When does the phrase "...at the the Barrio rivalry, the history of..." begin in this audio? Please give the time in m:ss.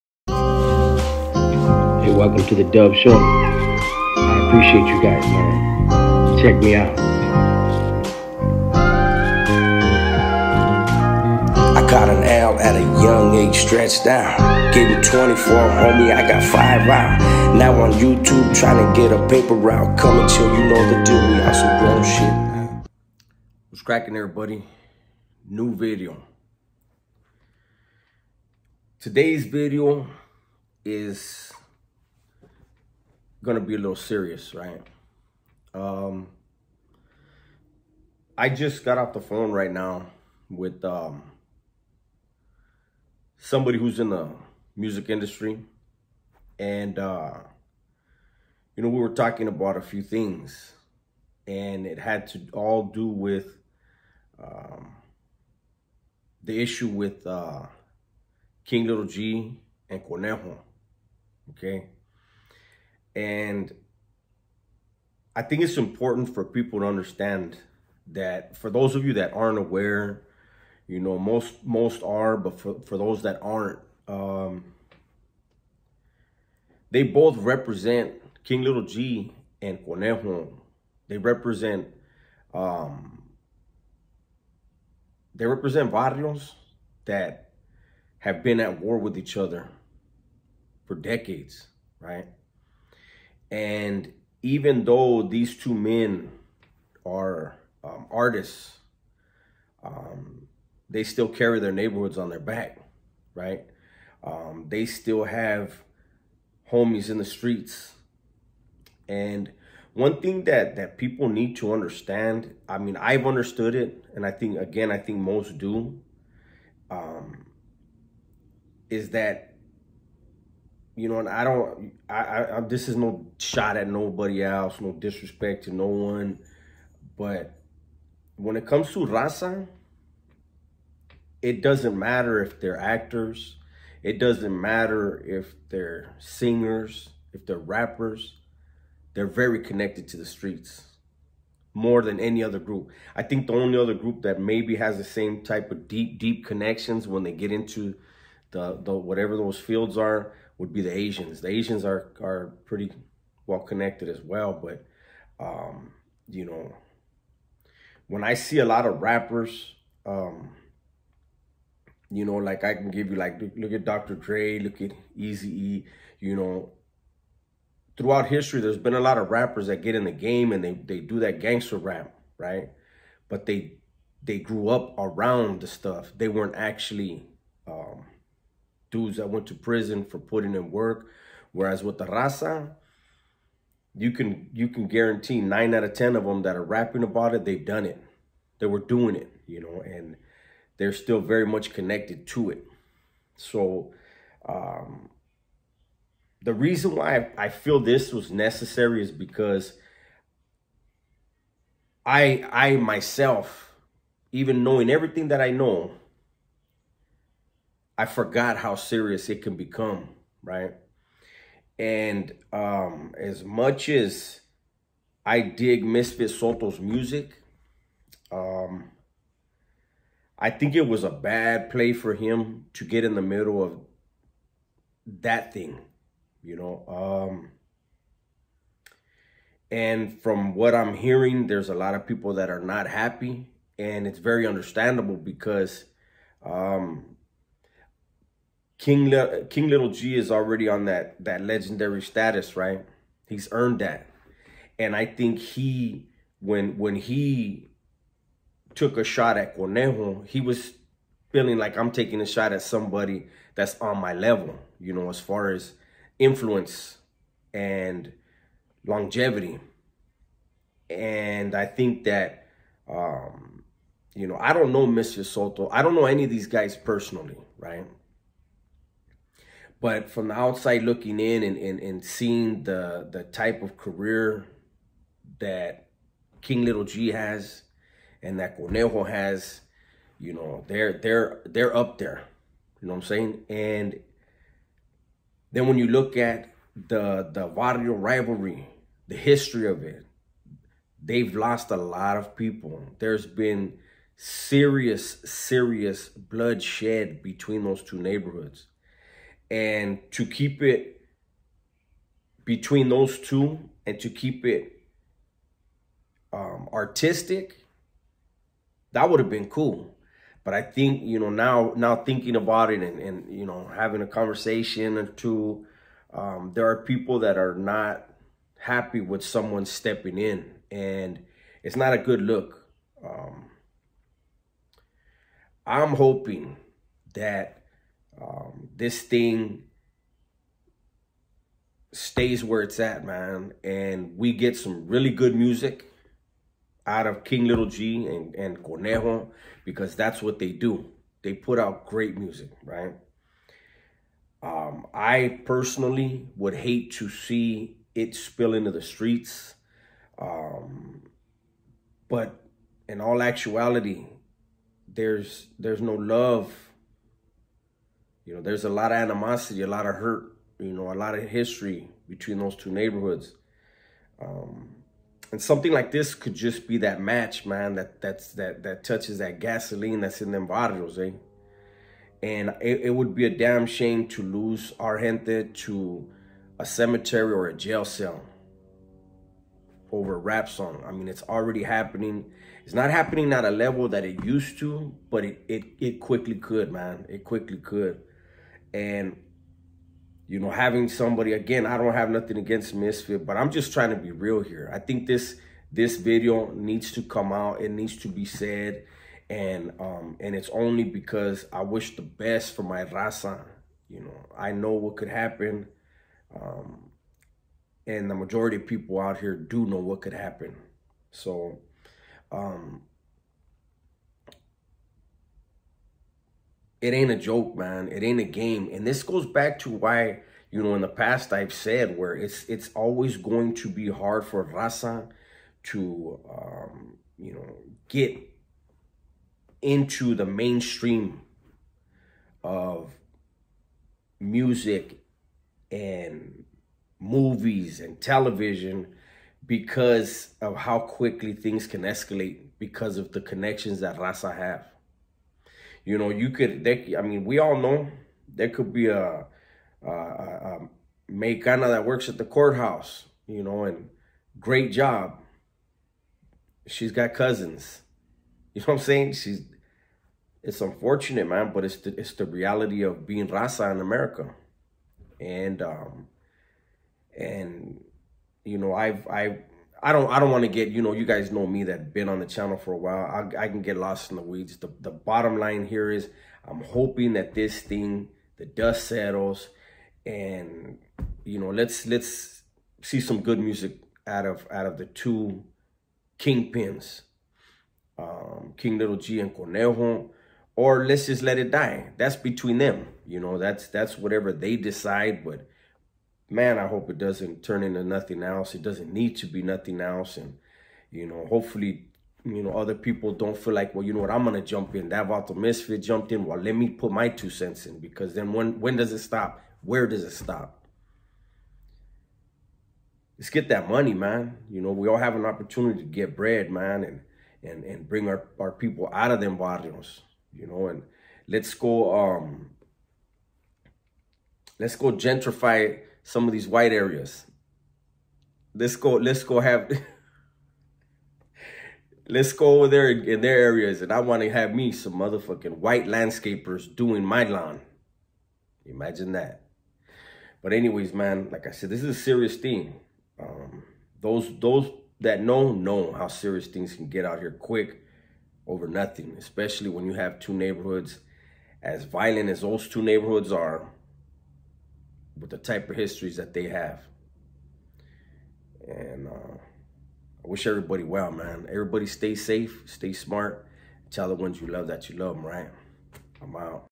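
4:46.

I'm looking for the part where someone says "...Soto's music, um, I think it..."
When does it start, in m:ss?
3:36.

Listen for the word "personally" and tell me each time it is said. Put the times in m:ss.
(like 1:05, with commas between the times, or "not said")
4:26, 5:45.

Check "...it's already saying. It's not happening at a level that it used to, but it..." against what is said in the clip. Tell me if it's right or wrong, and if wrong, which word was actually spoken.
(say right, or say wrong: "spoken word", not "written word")
wrong: "happening", not "saying".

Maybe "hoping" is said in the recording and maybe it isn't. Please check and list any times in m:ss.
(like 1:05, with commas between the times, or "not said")
5:25, 7:56.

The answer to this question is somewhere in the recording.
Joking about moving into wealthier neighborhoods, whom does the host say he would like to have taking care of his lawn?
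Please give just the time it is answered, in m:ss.
8:55.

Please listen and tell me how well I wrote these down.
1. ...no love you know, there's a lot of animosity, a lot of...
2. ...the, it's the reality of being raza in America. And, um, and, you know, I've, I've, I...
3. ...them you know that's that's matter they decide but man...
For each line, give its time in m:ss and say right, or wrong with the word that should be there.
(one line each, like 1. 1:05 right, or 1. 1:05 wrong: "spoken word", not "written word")
1. 5:55 right
2. 7:41 right
3. 8:12 wrong: "whatever", not "matter".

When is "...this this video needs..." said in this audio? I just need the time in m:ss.
6:35.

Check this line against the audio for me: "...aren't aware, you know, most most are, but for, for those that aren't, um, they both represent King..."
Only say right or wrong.
right.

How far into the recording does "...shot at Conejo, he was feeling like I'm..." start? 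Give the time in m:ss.
4:09.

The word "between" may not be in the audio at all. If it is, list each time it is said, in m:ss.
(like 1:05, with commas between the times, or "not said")
4:57, 5:02, 6:02, 8:12.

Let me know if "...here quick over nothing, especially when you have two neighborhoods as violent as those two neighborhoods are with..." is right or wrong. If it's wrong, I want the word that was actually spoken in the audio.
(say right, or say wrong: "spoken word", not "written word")
right.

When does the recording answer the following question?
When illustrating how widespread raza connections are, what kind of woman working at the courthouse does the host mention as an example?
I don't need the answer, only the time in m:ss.
7:31.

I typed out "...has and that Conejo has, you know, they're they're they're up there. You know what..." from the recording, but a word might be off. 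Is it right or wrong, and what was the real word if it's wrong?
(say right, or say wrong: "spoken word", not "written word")
right.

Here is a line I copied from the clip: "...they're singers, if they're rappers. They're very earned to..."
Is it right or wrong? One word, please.
wrong.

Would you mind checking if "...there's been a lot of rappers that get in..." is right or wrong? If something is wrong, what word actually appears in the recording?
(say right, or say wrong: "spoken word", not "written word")
right.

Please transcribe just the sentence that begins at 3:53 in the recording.
And it's very understandable because um, King Le King Little G is already on that that legendary status, right?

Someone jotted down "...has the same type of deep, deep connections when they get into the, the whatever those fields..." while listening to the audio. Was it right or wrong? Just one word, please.
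right.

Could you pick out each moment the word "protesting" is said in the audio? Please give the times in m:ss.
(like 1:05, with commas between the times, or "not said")
not said.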